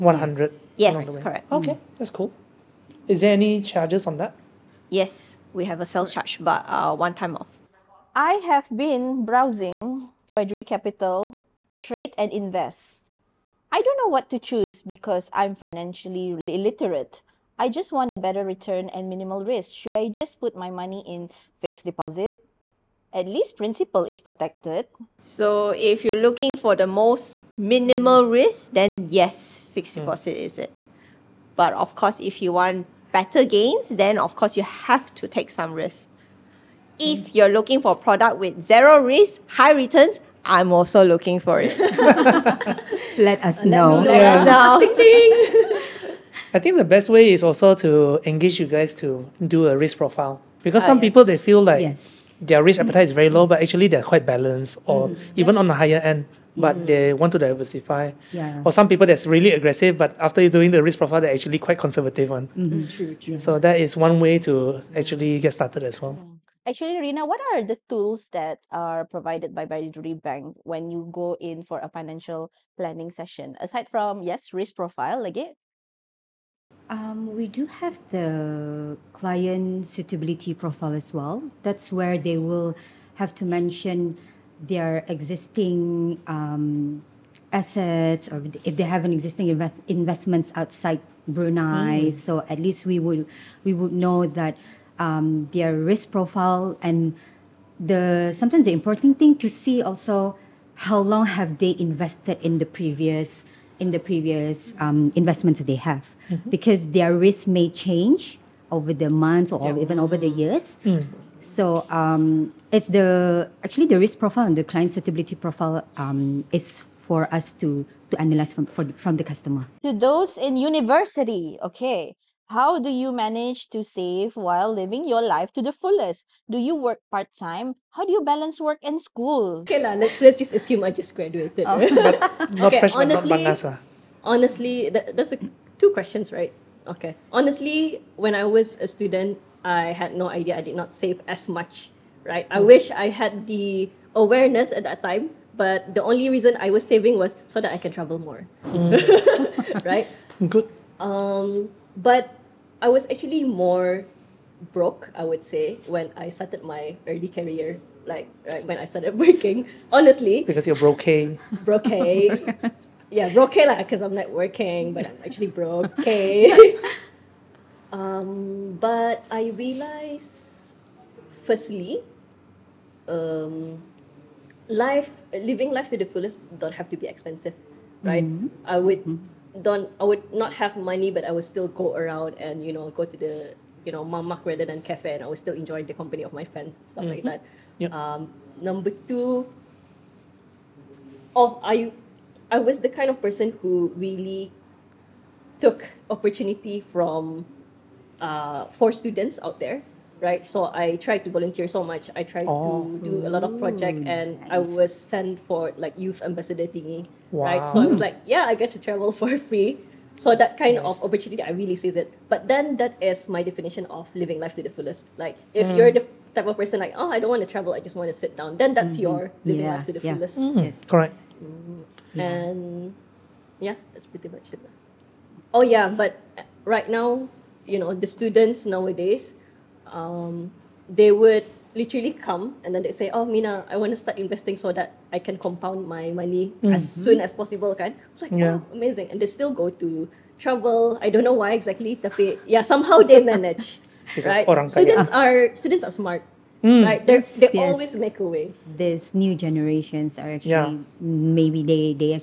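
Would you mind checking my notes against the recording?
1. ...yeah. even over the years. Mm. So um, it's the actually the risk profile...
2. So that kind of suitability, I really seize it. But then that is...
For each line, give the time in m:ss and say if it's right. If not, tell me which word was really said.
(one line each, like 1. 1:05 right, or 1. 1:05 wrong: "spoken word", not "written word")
1. 1:49 right
2. 3:30 wrong: "opportunity", not "suitability".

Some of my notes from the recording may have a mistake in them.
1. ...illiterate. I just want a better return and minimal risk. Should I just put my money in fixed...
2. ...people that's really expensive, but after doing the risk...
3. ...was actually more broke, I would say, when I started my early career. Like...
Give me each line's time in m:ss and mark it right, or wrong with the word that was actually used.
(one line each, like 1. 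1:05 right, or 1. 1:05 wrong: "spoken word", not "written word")
1. 0:16 right
2. 0:58 wrong: "aggressive", not "expensive"
3. 2:32 right.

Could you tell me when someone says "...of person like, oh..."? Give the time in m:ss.
3:36.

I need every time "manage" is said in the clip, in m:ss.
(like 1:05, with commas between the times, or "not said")
2:03, 4:03.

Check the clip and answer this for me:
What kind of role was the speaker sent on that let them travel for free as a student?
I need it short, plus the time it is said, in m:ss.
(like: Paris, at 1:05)
youth ambassador, at 3:25.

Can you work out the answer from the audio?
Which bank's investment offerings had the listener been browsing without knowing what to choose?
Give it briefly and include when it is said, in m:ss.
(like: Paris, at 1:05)
Baiduri Capital, at 0:10.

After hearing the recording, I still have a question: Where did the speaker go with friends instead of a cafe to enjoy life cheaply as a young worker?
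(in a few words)
mamak.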